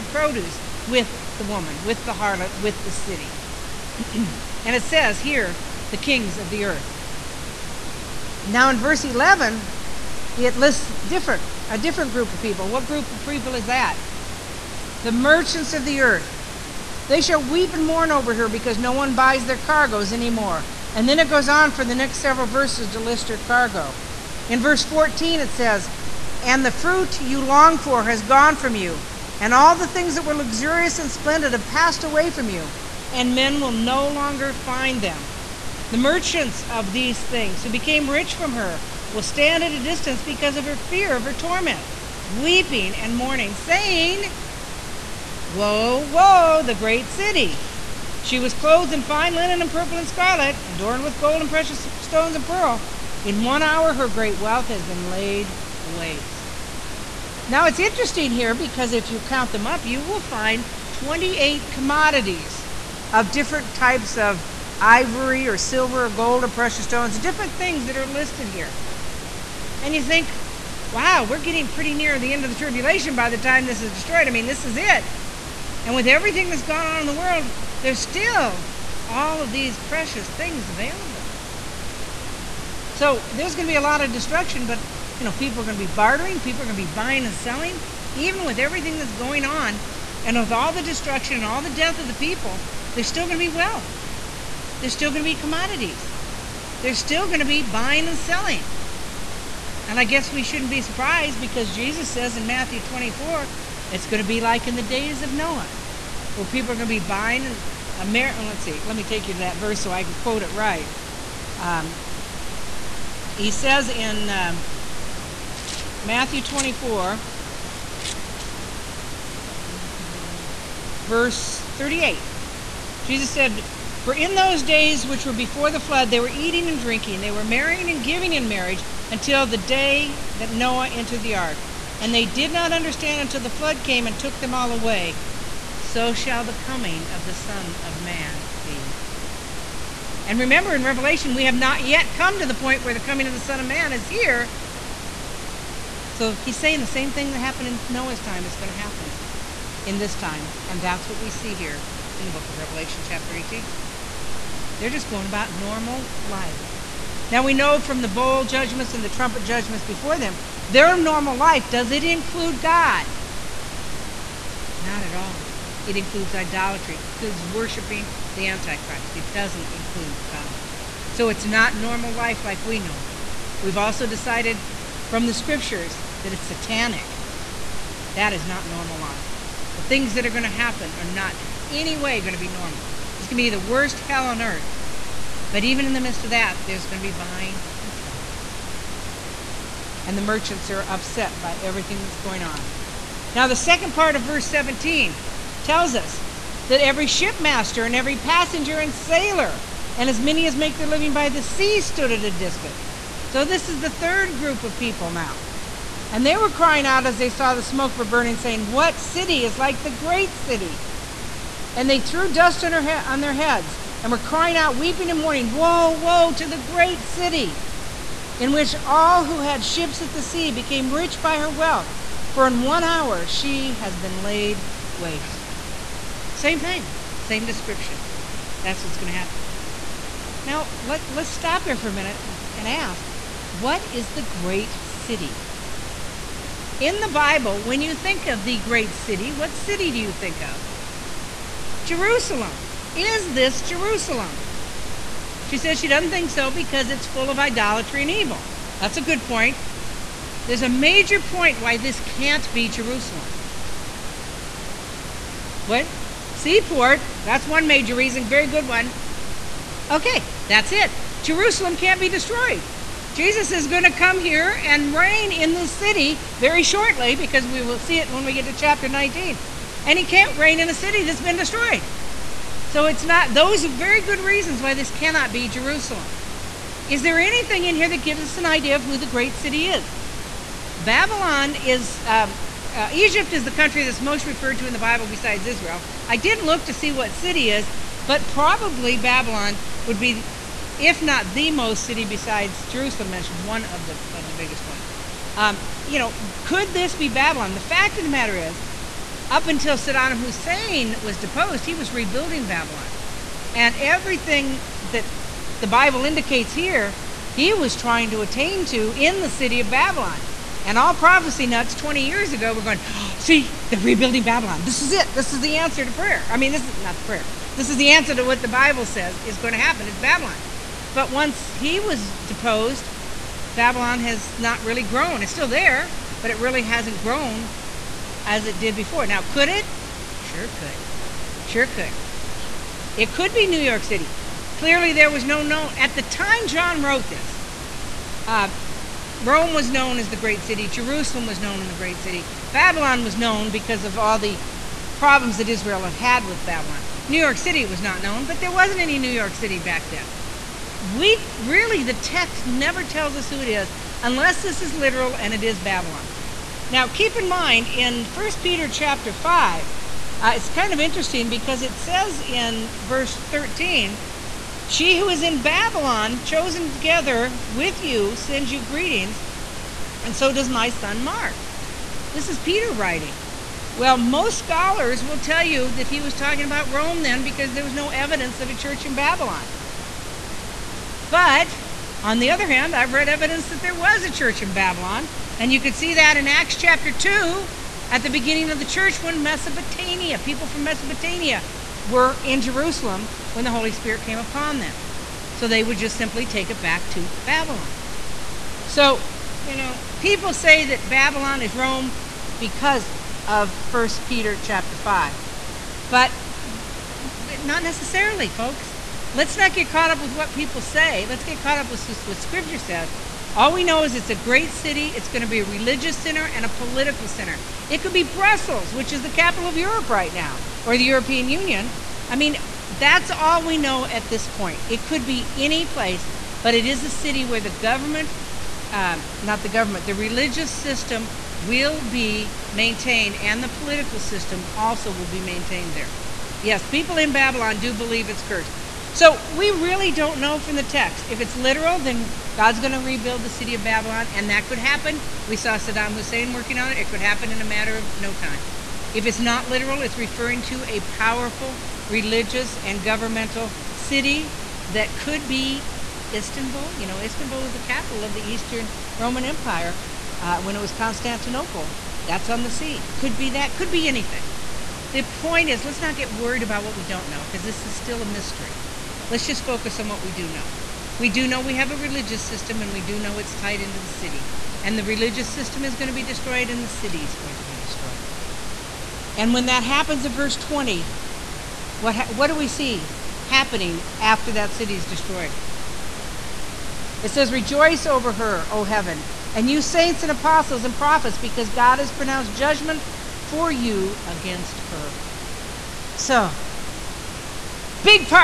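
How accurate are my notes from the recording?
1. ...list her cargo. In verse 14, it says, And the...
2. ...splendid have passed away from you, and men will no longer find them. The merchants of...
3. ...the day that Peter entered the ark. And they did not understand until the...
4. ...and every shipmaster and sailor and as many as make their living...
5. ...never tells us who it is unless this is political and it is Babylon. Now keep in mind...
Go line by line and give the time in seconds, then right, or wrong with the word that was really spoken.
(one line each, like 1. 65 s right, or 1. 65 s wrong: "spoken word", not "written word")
1. 22 s right
2. 31 s right
3. 129 s wrong: "Noah", not "Peter"
4. 197 s wrong: "passenger", not "shipmaster"
5. 352 s wrong: "literal", not "political".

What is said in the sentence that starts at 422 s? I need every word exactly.
I mean, that's all we know at this point.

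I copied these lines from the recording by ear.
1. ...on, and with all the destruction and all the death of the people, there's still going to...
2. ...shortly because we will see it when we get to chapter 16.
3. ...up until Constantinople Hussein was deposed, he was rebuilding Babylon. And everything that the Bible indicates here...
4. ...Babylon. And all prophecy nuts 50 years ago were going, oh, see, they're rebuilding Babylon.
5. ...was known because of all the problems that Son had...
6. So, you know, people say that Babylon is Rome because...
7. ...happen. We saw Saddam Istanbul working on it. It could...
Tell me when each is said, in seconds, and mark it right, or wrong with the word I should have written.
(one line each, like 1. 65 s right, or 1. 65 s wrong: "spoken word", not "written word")
1. 89 s right
2. 266 s wrong: "19", not "16"
3. 299 s wrong: "Saddam", not "Constantinople"
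4. 309 s wrong: "20", not "50"
5. 343 s wrong: "Israel", not "Son"
6. 398 s right
7. 444 s wrong: "Hussein", not "Istanbul".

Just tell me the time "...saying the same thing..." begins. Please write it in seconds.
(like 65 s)
146 s.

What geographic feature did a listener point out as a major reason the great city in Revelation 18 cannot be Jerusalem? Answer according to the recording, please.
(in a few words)
Seaport.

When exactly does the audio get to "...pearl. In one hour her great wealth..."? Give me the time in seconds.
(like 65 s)
52 s.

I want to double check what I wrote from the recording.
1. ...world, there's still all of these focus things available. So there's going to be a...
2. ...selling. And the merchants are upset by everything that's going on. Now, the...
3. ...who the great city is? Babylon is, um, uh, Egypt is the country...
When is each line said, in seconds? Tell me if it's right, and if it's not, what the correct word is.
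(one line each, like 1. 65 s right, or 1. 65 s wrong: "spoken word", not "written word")
1. 77 s wrong: "precious", not "focus"
2. 187 s right
3. 278 s right.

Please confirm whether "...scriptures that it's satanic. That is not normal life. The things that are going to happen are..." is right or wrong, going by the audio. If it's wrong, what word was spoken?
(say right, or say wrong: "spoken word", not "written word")
right.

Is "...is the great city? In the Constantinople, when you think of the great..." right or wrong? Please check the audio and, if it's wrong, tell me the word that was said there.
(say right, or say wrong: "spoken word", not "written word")
wrong: "Bible", not "Constantinople".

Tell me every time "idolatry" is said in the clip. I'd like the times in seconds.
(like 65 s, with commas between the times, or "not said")
166 s, 247 s.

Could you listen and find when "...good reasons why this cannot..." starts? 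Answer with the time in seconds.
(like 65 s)
274 s.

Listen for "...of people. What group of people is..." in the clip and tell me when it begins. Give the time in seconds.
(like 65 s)
12 s.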